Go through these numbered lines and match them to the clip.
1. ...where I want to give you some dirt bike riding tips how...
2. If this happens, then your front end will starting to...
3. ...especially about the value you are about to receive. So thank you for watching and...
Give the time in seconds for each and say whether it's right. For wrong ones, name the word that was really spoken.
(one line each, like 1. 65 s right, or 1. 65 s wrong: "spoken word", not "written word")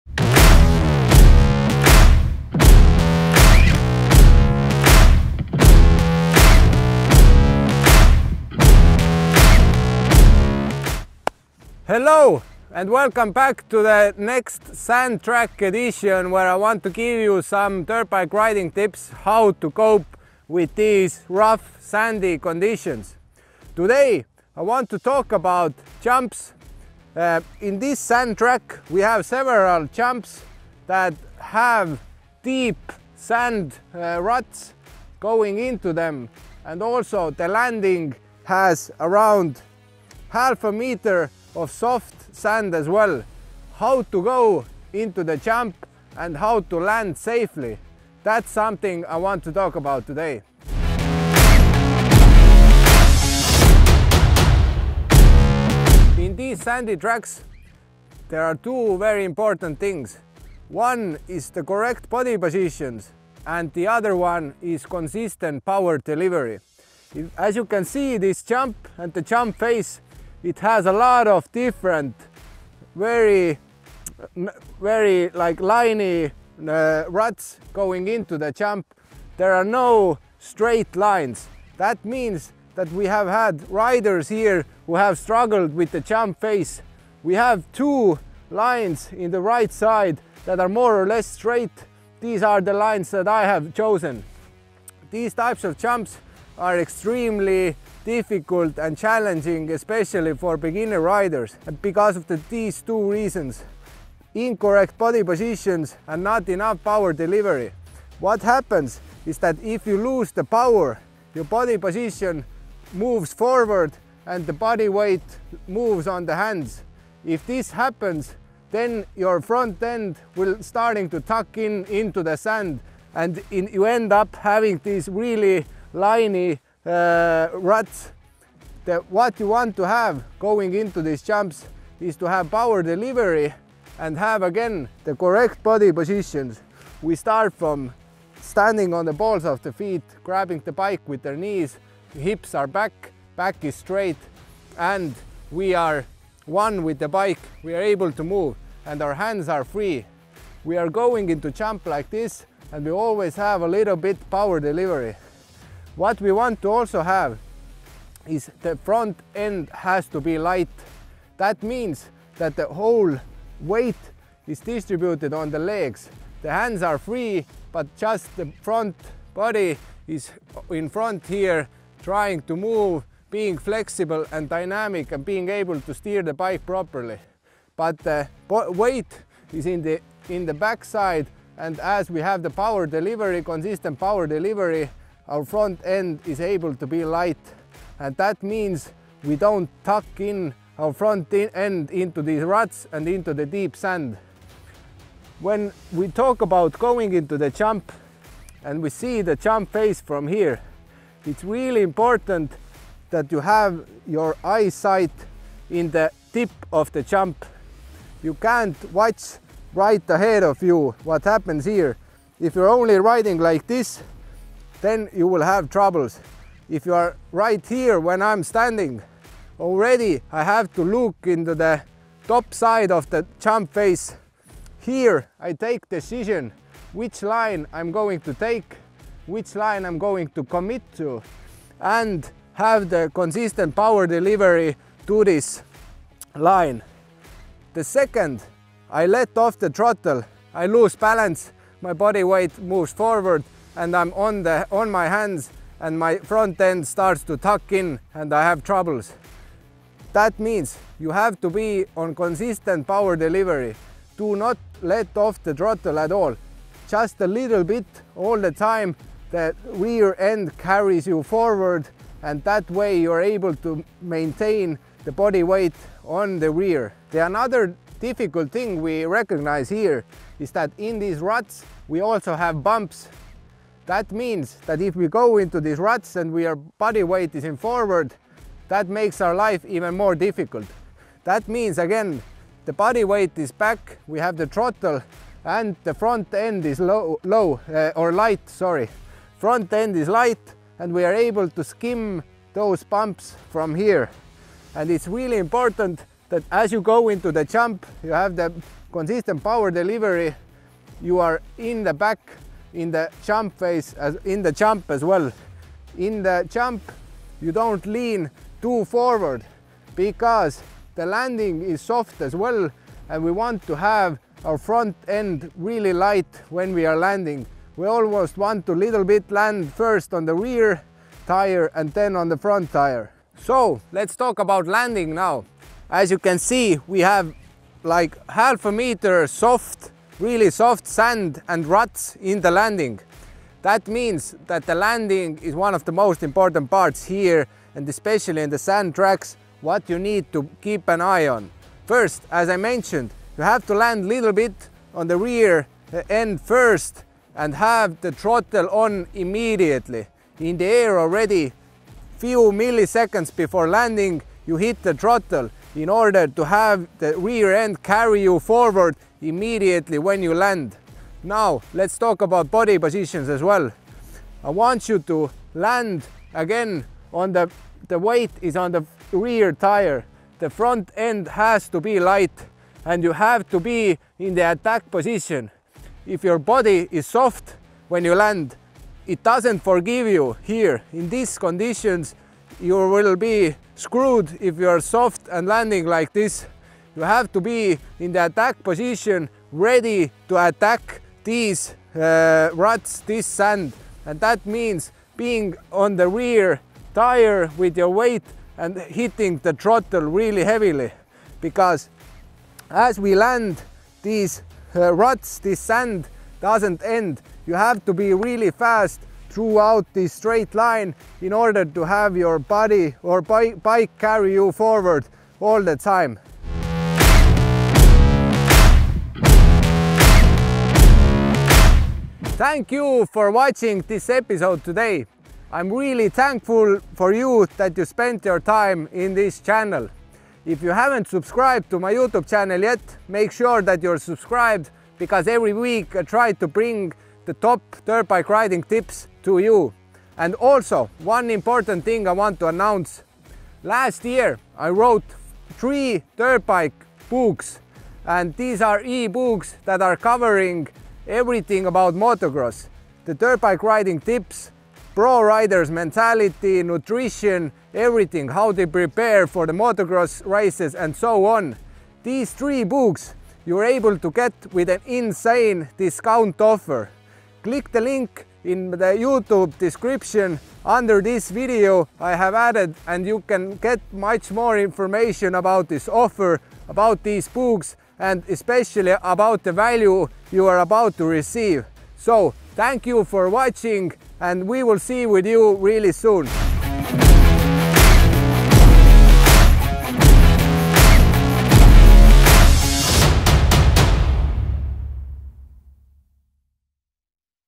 1. 16 s right
2. 117 s right
3. 478 s right.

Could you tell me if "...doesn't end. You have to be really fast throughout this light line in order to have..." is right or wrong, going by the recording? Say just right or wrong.
wrong.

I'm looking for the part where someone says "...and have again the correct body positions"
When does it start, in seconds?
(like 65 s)
133 s.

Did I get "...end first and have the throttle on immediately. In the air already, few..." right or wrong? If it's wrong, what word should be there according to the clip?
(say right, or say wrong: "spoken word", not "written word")
right.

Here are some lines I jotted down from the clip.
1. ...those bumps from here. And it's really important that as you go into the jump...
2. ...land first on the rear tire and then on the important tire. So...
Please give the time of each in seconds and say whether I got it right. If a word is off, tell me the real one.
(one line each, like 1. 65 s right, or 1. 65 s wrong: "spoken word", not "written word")
1. 292 s right
2. 319 s wrong: "front", not "important".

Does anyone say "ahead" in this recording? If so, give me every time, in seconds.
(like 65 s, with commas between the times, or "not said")
210 s.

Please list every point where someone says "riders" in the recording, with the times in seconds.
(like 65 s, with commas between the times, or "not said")
83 s, 101 s, 455 s.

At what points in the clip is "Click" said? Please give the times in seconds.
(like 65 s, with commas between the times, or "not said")
467 s.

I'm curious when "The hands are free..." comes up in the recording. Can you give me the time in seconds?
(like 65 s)
166 s.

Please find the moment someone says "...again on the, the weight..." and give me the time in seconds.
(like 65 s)
366 s.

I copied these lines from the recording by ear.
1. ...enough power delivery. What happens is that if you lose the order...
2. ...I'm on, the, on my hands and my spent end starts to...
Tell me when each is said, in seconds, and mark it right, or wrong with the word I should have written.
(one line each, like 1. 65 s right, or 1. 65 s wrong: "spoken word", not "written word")
1. 106 s wrong: "power", not "order"
2. 243 s wrong: "front", not "spent".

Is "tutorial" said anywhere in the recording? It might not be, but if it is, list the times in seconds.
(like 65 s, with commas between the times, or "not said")
not said.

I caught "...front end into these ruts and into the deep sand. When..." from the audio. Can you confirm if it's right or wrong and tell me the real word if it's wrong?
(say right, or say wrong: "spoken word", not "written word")
right.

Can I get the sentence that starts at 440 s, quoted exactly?
And also, one important thing I want to announce.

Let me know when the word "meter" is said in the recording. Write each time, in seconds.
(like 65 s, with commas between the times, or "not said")
40 s, 328 s.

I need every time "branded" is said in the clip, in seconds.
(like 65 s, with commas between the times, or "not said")
not said.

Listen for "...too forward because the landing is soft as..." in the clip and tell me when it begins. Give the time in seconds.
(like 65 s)
308 s.